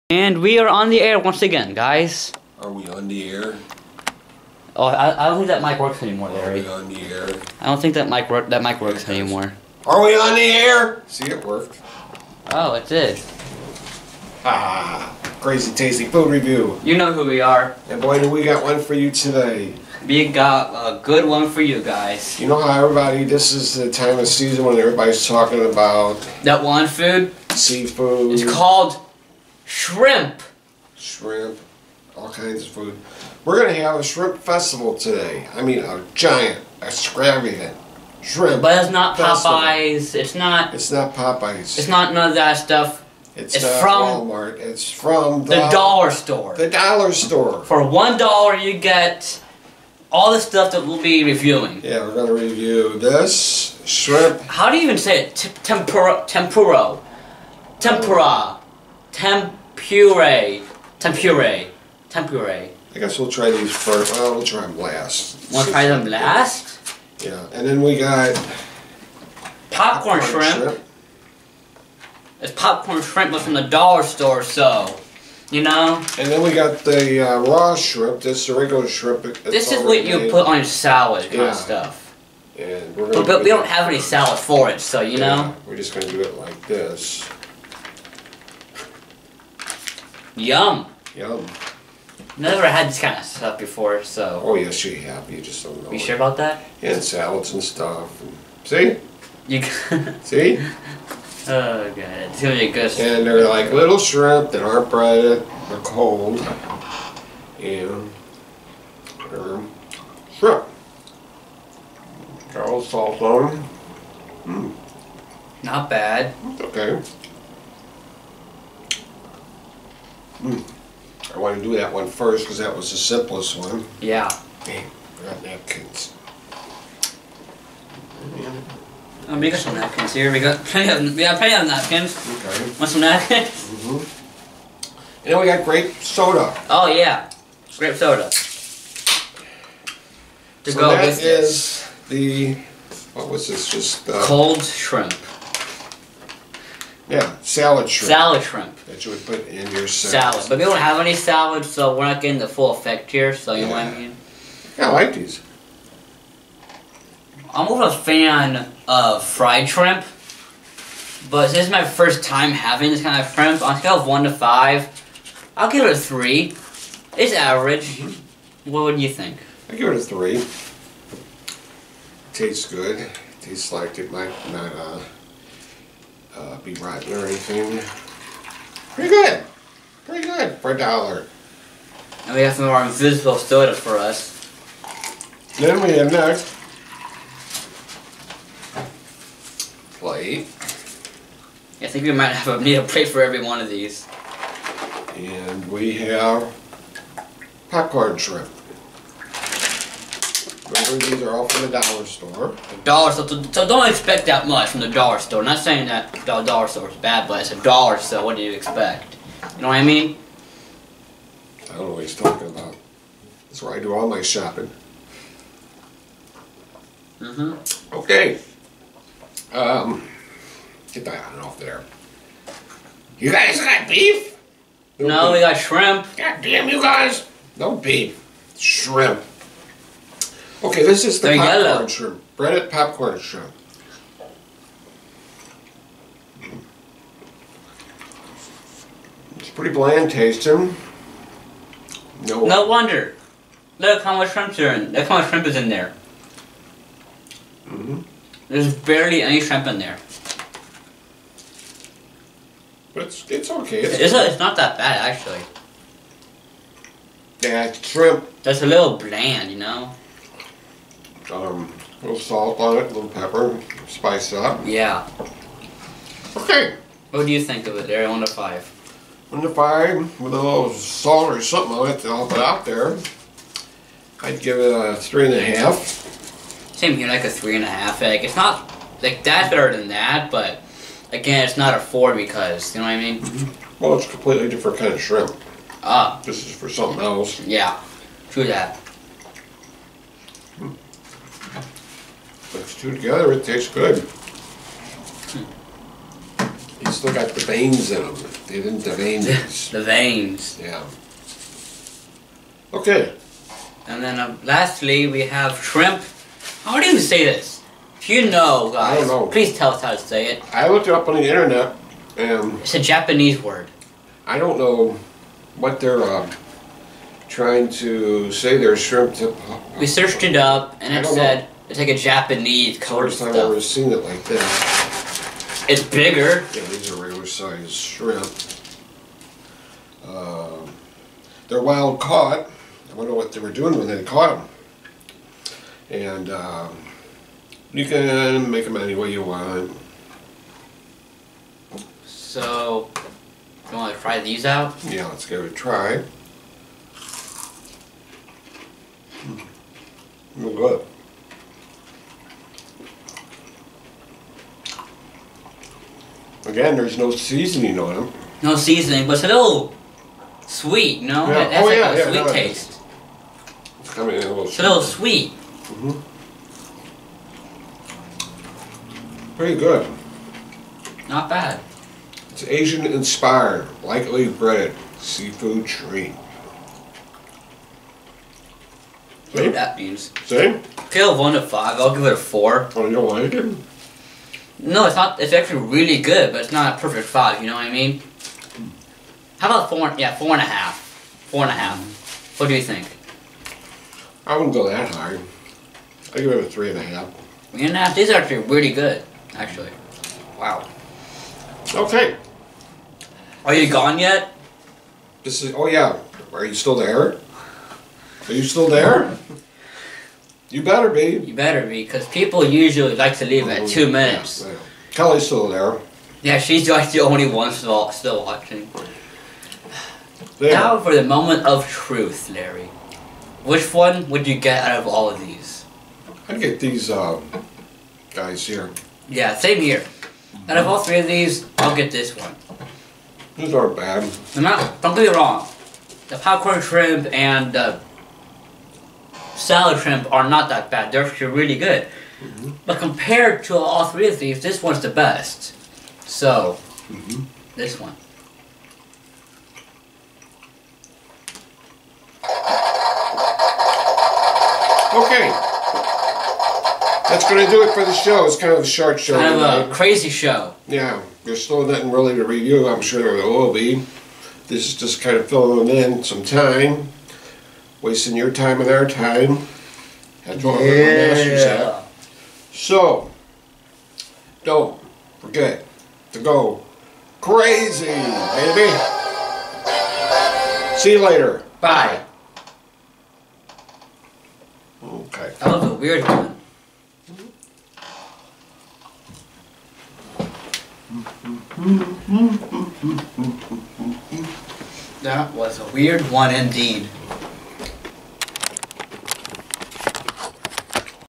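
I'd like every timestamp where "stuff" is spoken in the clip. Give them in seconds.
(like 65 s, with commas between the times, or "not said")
42 s, 50 s, 81 s, 93 s, 97 s, 323 s.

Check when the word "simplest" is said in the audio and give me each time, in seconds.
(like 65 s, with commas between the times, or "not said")
122 s.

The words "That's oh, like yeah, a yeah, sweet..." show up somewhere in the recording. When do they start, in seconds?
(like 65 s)
361 s.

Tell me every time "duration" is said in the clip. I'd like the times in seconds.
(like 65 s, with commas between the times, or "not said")
not said.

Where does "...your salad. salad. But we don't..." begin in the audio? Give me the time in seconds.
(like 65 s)
149 s.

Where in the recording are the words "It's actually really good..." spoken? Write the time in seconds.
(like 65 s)
385 s.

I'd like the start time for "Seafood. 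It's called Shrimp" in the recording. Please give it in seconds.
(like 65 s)
27 s.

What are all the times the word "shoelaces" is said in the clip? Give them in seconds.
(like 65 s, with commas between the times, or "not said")
not said.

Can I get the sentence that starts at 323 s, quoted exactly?
First time I've ever seen it like that.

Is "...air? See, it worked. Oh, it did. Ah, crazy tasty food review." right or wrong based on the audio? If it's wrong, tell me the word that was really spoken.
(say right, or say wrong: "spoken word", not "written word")
right.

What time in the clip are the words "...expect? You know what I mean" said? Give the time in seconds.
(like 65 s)
208 s.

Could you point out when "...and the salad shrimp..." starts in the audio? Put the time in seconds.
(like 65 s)
437 s.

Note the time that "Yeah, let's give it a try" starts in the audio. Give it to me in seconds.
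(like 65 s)
344 s.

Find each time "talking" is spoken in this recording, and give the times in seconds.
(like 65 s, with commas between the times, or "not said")
25 s, 212 s.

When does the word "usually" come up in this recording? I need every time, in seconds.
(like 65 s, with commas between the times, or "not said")
412 s.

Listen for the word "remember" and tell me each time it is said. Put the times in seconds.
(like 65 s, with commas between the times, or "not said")
200 s.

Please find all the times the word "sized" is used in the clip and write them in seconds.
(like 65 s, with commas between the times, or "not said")
327 s.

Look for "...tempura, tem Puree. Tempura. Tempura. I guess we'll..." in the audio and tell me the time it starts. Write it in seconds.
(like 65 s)
57 s.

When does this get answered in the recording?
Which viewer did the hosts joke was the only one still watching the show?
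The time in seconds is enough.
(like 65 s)
414 s.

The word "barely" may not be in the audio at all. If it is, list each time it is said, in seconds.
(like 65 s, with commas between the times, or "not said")
248 s.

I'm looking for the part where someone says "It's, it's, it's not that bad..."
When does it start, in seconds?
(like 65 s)
253 s.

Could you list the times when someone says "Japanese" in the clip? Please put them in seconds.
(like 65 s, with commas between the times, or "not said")
312 s, 321 s.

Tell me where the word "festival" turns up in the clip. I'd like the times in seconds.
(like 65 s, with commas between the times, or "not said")
34 s, 39 s.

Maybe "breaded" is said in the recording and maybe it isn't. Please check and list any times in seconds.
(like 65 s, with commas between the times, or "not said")
104 s, 232 s, 374 s.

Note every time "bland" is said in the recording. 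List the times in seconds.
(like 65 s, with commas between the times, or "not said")
239 s, 258 s.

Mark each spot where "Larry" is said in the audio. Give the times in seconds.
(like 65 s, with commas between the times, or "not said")
6 s, 422 s.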